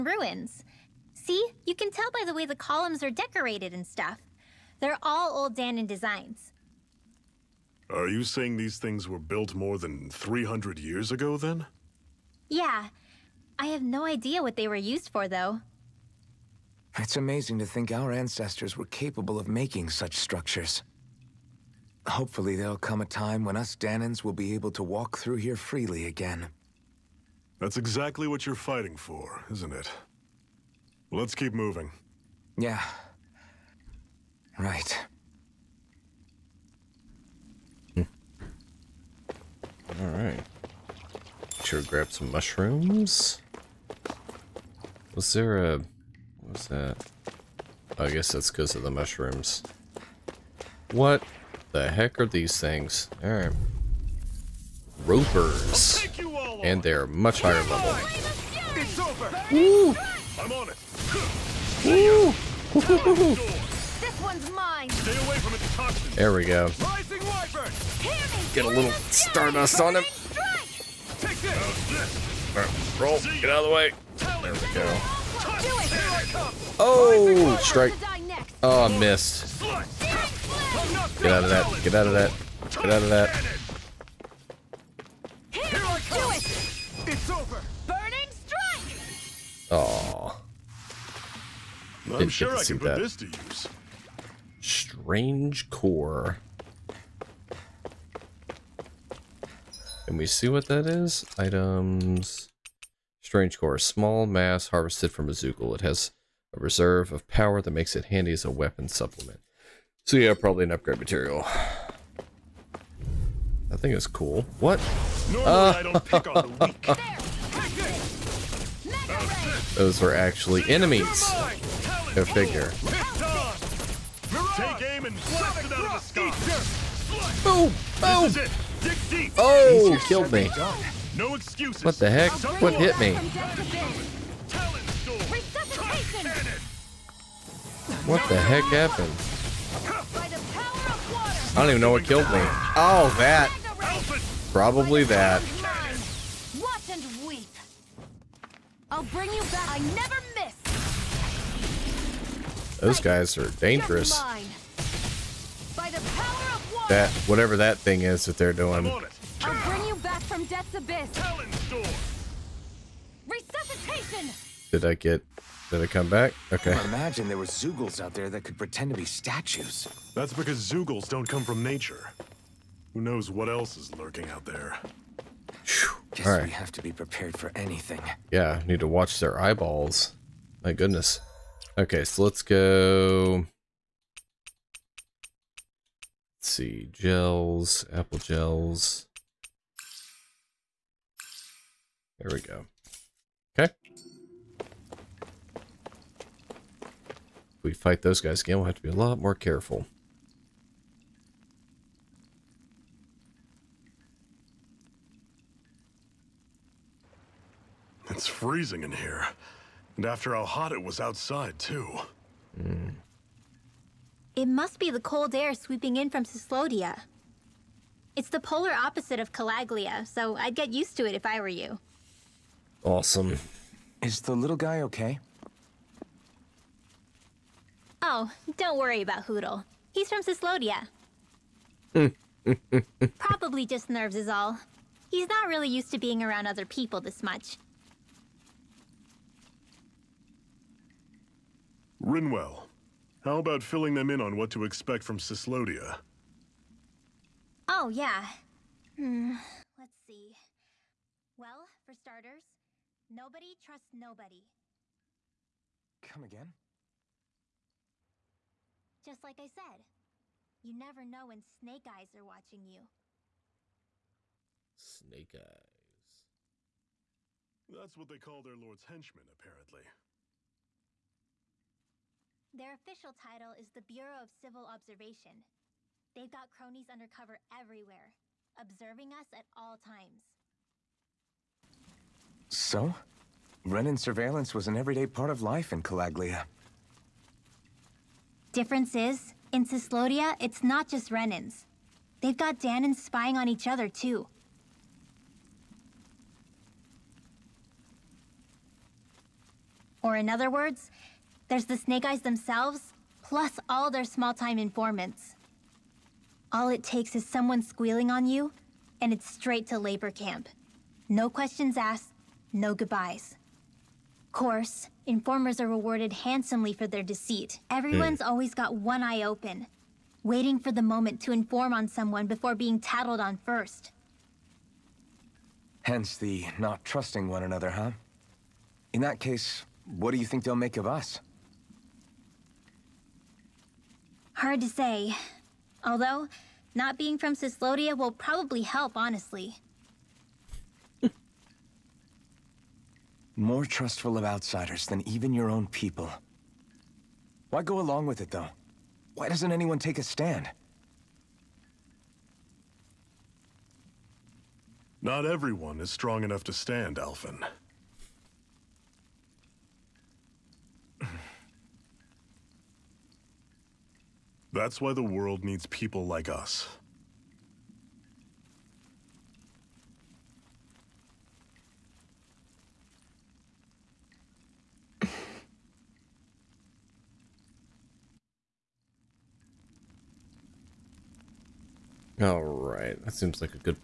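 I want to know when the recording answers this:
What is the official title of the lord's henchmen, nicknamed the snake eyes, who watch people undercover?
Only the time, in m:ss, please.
4:33.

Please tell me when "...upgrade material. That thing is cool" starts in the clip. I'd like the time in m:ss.
1:50.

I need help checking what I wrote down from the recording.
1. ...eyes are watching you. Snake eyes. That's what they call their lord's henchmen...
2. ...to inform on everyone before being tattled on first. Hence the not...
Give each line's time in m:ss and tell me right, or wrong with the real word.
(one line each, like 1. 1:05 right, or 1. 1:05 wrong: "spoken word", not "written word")
1. 4:21 right
2. 5:21 wrong: "someone", not "everyone".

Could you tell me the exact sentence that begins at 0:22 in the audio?
Hopefully there'll come a time when us Dahnans will be able to walk through here freely again.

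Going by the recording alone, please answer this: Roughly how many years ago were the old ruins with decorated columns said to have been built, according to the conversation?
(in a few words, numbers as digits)
300.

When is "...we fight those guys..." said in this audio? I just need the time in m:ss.
3:17.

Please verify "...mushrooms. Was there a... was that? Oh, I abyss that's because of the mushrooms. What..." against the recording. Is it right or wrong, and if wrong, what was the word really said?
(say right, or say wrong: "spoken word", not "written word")
wrong: "guess", not "abyss".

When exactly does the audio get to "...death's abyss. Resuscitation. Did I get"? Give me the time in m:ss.
2:40.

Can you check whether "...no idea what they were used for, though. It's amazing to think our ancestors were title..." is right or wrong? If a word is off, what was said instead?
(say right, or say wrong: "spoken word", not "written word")
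wrong: "capable", not "title".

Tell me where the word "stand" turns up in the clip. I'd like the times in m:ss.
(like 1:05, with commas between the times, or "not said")
5:50, 5:56.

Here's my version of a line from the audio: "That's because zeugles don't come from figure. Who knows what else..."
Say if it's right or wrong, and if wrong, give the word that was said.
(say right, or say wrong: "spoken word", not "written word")
wrong: "nature", not "figure".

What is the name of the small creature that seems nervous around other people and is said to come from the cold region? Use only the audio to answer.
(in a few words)
Hootle.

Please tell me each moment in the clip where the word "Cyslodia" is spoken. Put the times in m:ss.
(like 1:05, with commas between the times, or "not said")
3:36, 3:50, 4:05, 4:49, 5:37.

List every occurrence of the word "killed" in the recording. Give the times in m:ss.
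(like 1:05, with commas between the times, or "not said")
2:10, 2:22.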